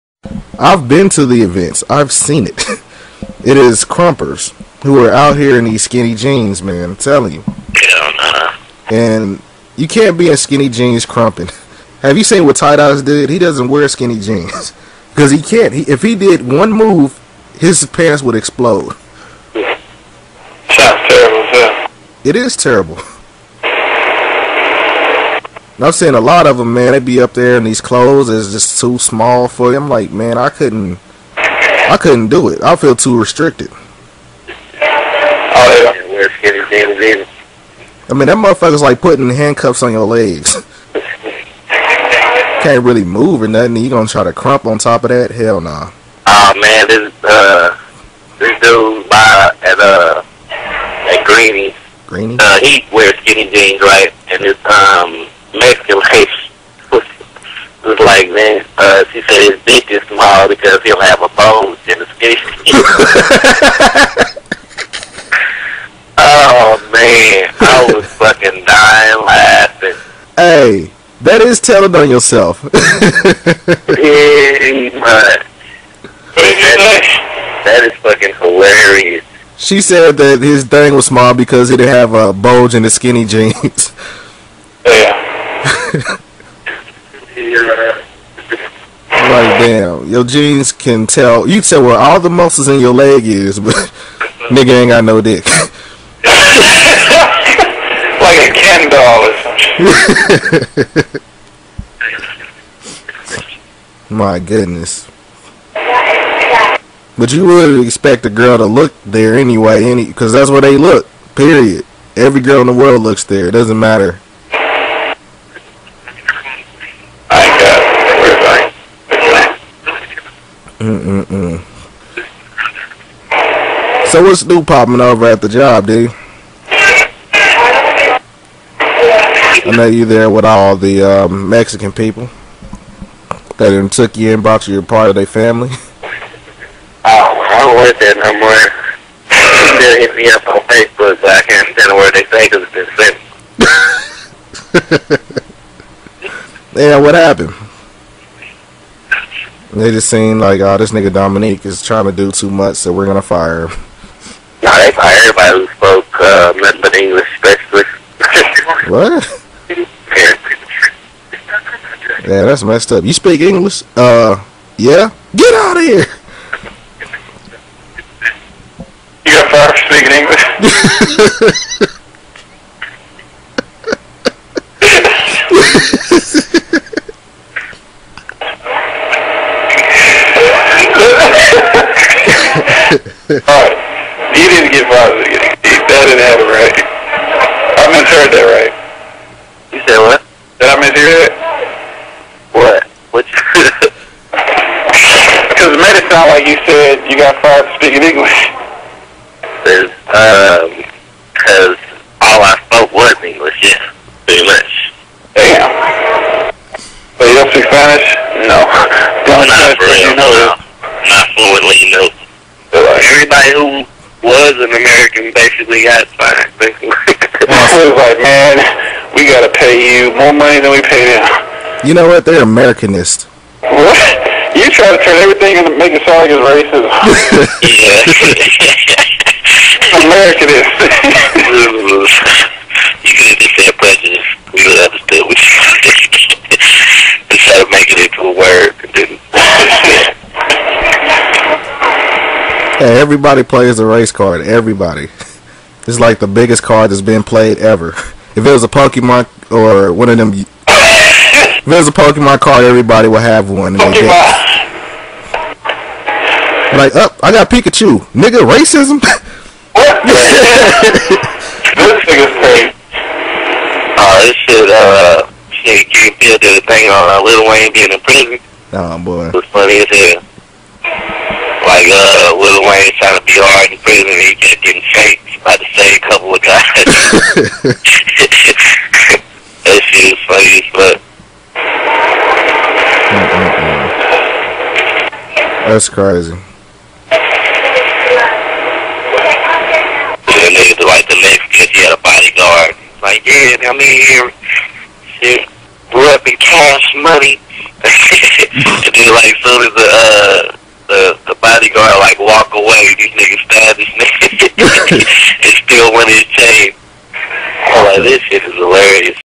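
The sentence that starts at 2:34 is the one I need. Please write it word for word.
Nah, they fired everybody who spoke uh, English, especially.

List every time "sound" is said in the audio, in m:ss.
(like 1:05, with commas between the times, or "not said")
0:20, 3:16, 3:46.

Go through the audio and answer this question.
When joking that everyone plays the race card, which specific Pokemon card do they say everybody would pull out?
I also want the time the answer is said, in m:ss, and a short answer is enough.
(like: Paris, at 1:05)
Pikachu, at 4:17.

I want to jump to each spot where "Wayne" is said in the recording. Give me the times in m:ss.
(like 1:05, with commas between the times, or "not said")
4:27, 4:32.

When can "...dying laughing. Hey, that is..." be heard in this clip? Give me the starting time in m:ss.
1:08.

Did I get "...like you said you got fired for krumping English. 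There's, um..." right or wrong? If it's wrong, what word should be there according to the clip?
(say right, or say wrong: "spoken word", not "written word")
wrong: "speaking", not "krumping".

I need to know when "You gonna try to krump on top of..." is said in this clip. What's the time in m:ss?
0:43.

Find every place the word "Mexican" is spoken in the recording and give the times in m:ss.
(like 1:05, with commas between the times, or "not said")
2:11, 4:51.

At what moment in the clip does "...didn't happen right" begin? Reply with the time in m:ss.
3:06.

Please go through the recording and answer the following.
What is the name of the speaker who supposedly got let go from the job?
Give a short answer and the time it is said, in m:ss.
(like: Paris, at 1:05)
Dominique, at 2:31.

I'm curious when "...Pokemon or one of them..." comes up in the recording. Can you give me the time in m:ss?
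4:08.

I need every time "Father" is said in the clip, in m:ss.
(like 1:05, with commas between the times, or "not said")
3:04.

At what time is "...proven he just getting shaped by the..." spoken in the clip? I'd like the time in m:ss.
4:33.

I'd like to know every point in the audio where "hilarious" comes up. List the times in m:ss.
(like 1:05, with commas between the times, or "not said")
1:18.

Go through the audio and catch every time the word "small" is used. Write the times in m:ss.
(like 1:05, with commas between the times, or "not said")
0:28, 1:00, 1:21.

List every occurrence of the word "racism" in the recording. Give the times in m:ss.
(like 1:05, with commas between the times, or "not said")
3:46, 4:18.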